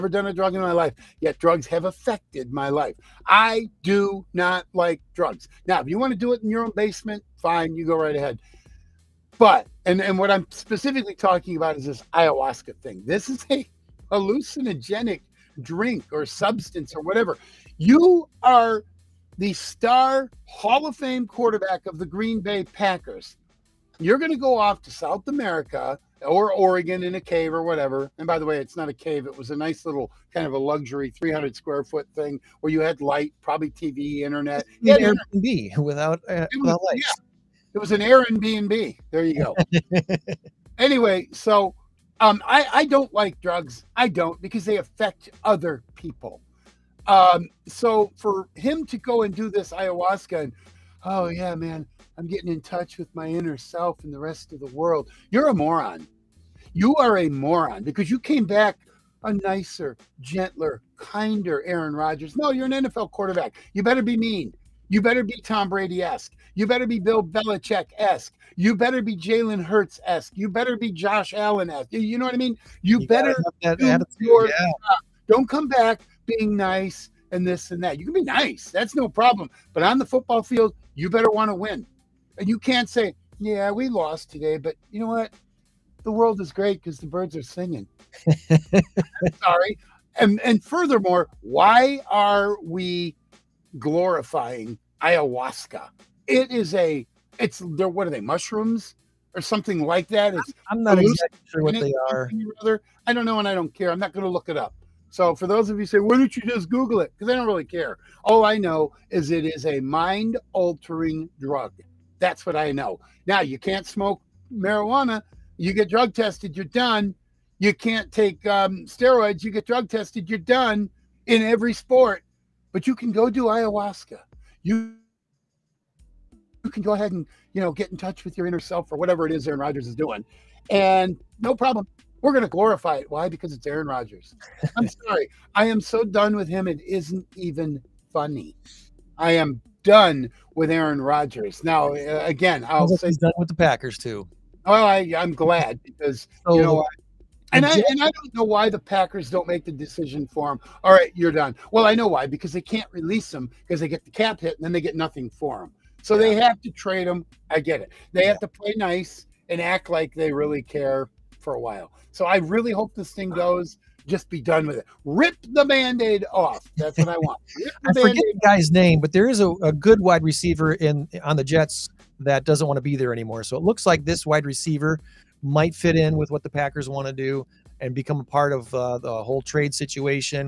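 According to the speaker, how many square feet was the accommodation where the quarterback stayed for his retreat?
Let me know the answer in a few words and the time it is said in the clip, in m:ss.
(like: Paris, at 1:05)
300, at 0:31.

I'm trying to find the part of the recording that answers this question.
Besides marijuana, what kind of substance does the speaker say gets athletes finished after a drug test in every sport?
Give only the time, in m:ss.
1:58.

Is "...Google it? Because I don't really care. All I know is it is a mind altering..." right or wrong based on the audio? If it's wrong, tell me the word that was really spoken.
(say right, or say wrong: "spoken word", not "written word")
right.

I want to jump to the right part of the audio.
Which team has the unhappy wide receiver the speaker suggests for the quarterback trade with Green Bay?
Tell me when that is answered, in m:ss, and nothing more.
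2:51.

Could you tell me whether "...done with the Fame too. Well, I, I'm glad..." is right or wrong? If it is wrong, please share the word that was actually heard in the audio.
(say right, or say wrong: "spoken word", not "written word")
wrong: "Packers", not "Fame".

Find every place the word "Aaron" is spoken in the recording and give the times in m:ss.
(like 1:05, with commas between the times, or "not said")
1:01, 2:09, 2:13, 2:20.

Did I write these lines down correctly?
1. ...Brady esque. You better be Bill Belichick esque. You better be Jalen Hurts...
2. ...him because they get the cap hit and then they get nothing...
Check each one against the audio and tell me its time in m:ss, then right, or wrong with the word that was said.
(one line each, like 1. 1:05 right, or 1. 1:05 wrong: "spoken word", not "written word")
1. 1:05 right
2. 2:33 right.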